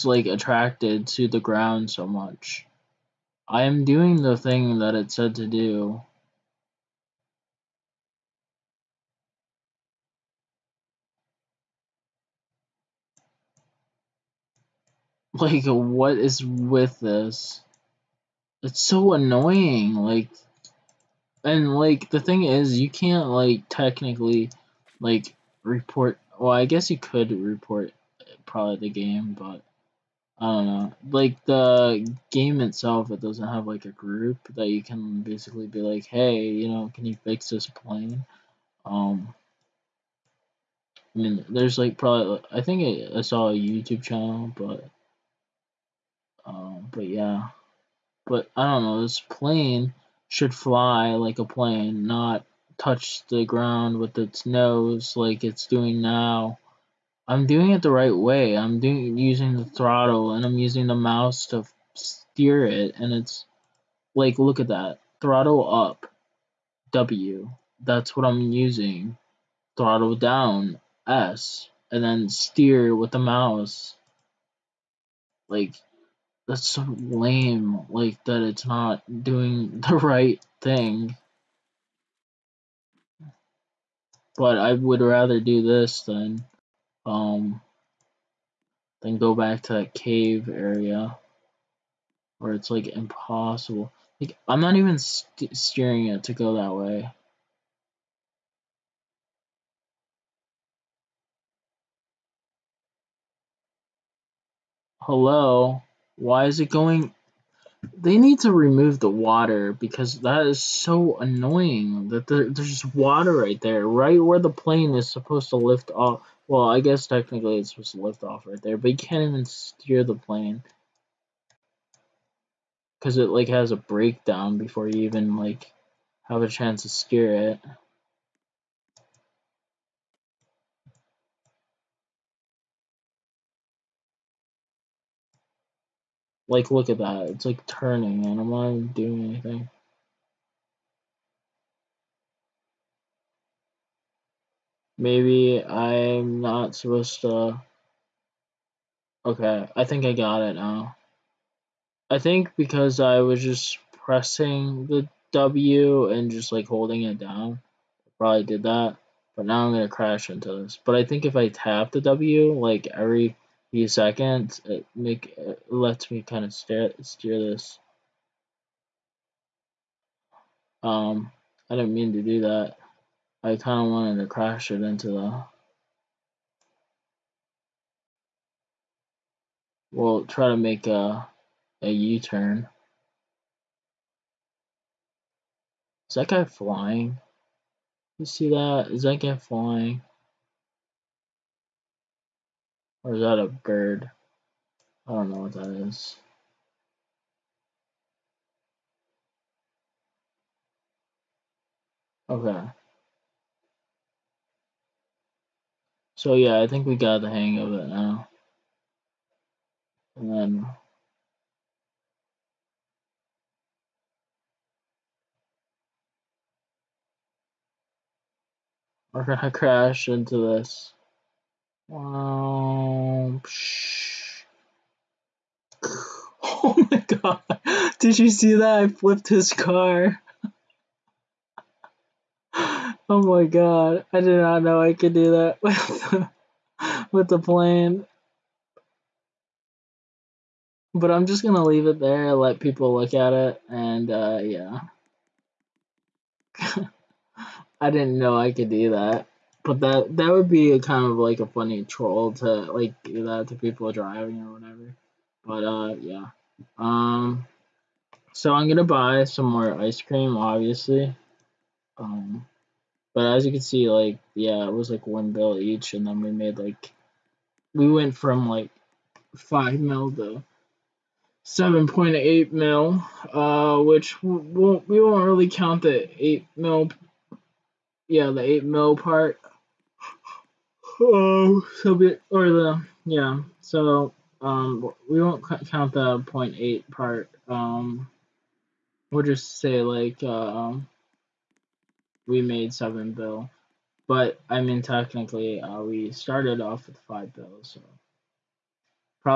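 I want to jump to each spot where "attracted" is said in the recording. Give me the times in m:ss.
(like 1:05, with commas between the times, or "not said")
0:00.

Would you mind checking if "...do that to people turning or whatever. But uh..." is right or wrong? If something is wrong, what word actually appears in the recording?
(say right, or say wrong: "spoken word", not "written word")
wrong: "driving", not "turning".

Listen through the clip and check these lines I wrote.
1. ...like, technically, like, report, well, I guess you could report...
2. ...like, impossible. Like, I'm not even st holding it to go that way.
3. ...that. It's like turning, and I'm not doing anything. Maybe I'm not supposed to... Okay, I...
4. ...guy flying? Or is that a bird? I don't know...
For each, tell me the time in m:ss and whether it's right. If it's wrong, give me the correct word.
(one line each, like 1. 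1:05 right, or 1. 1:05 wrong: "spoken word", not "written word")
1. 0:23 right
2. 1:32 wrong: "steering", not "holding"
3. 2:16 right
4. 3:09 right.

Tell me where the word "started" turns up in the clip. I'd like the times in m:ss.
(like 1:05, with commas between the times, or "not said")
4:56.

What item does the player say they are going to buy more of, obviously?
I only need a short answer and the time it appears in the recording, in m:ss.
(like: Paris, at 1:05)
ice cream, at 4:19.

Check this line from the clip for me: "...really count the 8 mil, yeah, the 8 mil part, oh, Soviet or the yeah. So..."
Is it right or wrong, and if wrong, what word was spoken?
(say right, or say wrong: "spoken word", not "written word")
right.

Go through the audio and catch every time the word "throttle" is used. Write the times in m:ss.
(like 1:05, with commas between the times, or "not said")
0:59, 1:05, 1:09.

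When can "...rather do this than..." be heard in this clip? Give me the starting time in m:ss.
1:24.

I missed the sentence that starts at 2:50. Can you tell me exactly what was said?
Um, I didn't mean to do that.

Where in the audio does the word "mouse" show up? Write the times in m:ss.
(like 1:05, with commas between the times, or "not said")
1:00, 1:13.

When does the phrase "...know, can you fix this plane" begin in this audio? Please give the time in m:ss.
0:36.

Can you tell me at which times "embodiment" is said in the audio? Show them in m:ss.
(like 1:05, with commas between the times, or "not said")
not said.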